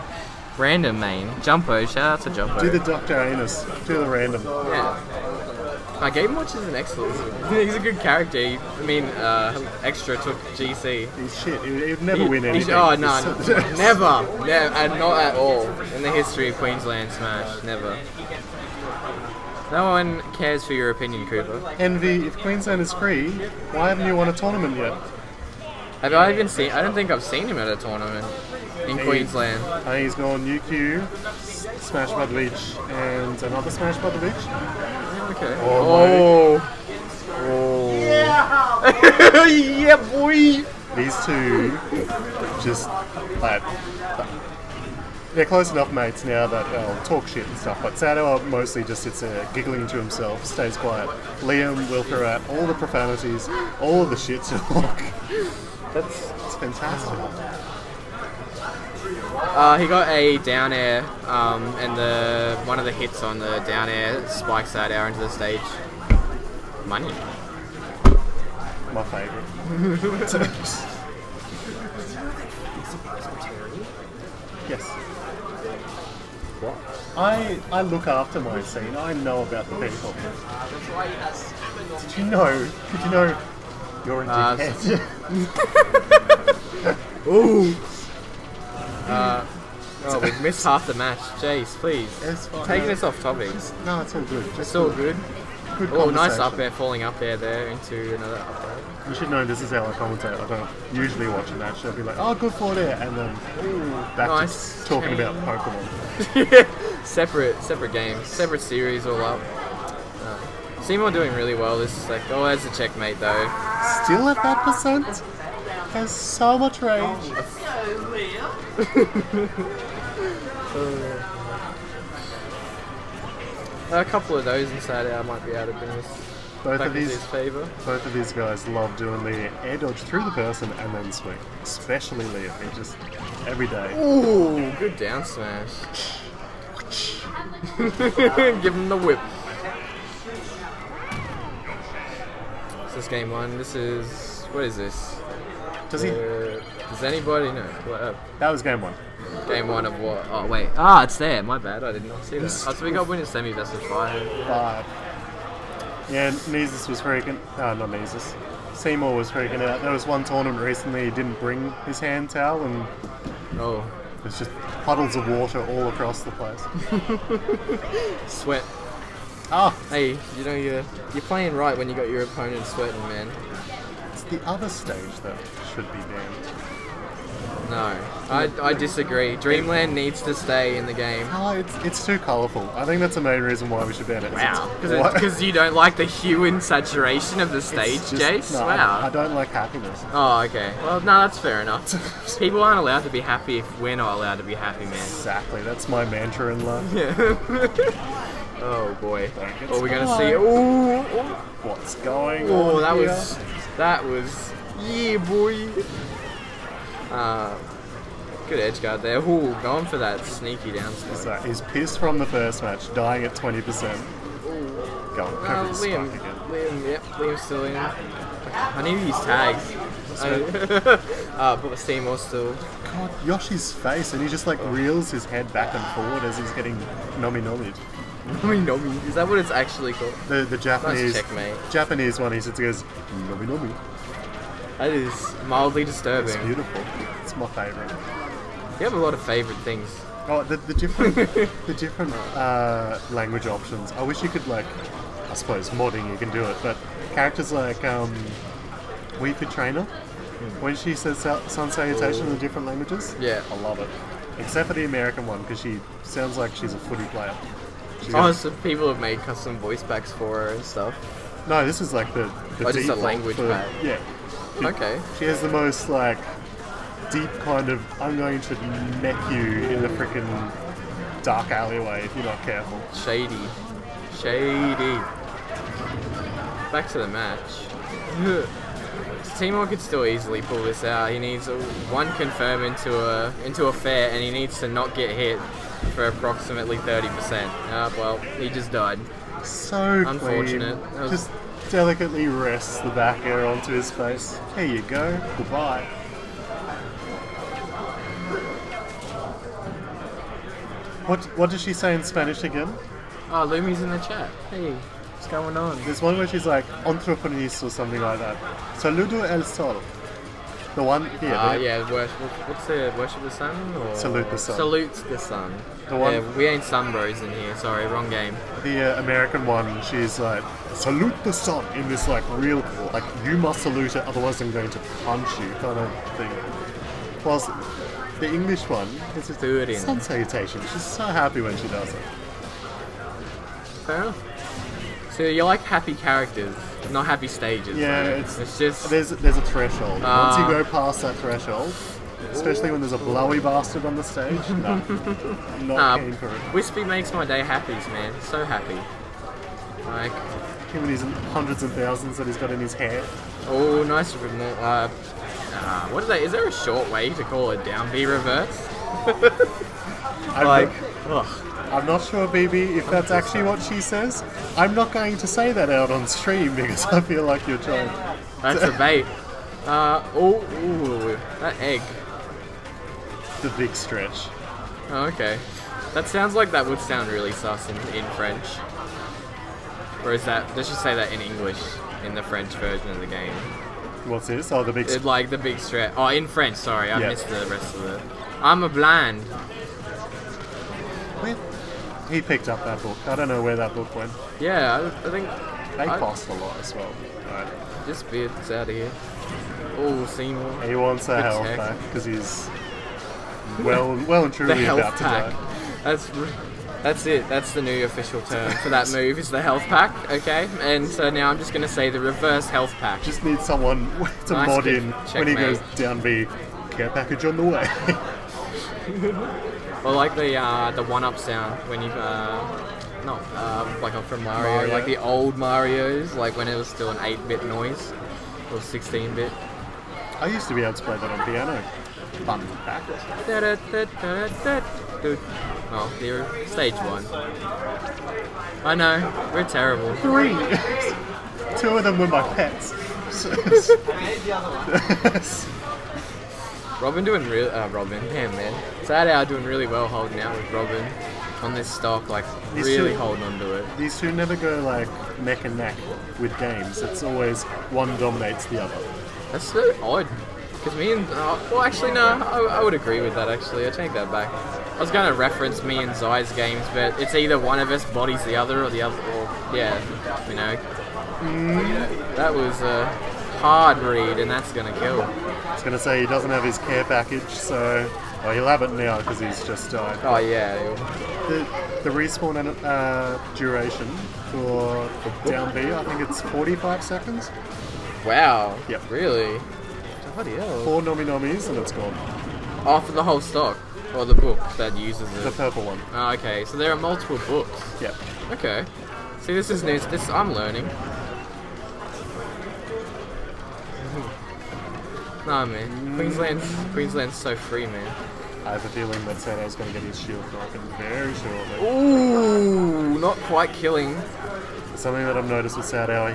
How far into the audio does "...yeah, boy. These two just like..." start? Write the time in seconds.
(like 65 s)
39 s.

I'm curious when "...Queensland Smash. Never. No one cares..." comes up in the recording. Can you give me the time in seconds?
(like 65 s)
16 s.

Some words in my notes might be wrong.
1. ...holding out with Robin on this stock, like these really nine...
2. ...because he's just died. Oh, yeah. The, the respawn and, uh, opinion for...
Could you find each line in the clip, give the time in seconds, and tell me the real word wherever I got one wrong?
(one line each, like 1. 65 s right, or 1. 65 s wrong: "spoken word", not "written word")
1. 449 s wrong: "two", not "nine"
2. 478 s wrong: "duration", not "opinion".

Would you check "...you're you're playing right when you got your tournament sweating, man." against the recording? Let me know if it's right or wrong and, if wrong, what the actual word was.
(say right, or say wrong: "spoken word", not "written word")
wrong: "opponent", not "tournament".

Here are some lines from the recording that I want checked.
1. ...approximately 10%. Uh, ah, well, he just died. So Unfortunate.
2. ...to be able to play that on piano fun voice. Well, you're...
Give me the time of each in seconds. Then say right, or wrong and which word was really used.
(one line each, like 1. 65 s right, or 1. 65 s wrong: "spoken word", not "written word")
1. 286 s wrong: "30", not "10"
2. 430 s wrong: "practice", not "voice".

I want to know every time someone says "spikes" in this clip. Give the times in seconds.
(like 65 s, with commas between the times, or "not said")
64 s, 216 s.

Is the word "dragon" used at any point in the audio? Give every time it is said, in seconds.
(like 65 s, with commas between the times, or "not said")
not said.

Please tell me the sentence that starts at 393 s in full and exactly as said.
I don't know where that book went.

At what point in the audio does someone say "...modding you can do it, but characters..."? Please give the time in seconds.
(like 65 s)
245 s.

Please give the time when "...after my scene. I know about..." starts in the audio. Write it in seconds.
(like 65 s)
78 s.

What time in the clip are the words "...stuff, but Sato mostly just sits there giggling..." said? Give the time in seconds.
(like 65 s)
47 s.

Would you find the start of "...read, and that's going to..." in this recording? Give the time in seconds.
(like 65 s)
473 s.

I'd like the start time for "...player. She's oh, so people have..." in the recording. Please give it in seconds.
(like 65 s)
257 s.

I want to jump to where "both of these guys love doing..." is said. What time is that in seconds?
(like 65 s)
127 s.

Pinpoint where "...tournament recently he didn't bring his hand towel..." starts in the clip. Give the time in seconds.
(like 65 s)
160 s.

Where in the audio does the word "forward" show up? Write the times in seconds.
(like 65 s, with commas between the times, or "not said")
102 s, 225 s.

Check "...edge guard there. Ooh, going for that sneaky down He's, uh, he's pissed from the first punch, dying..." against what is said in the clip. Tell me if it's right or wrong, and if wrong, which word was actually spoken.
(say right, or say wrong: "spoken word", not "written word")
wrong: "match", not "punch".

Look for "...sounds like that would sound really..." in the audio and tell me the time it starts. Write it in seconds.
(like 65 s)
376 s.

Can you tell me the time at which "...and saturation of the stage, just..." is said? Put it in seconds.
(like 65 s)
186 s.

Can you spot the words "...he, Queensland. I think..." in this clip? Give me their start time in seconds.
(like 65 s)
28 s.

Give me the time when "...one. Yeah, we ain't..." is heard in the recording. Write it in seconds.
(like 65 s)
315 s.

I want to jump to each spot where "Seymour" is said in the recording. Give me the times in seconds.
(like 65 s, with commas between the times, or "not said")
110 s, 158 s, 221 s, 279 s, 400 s.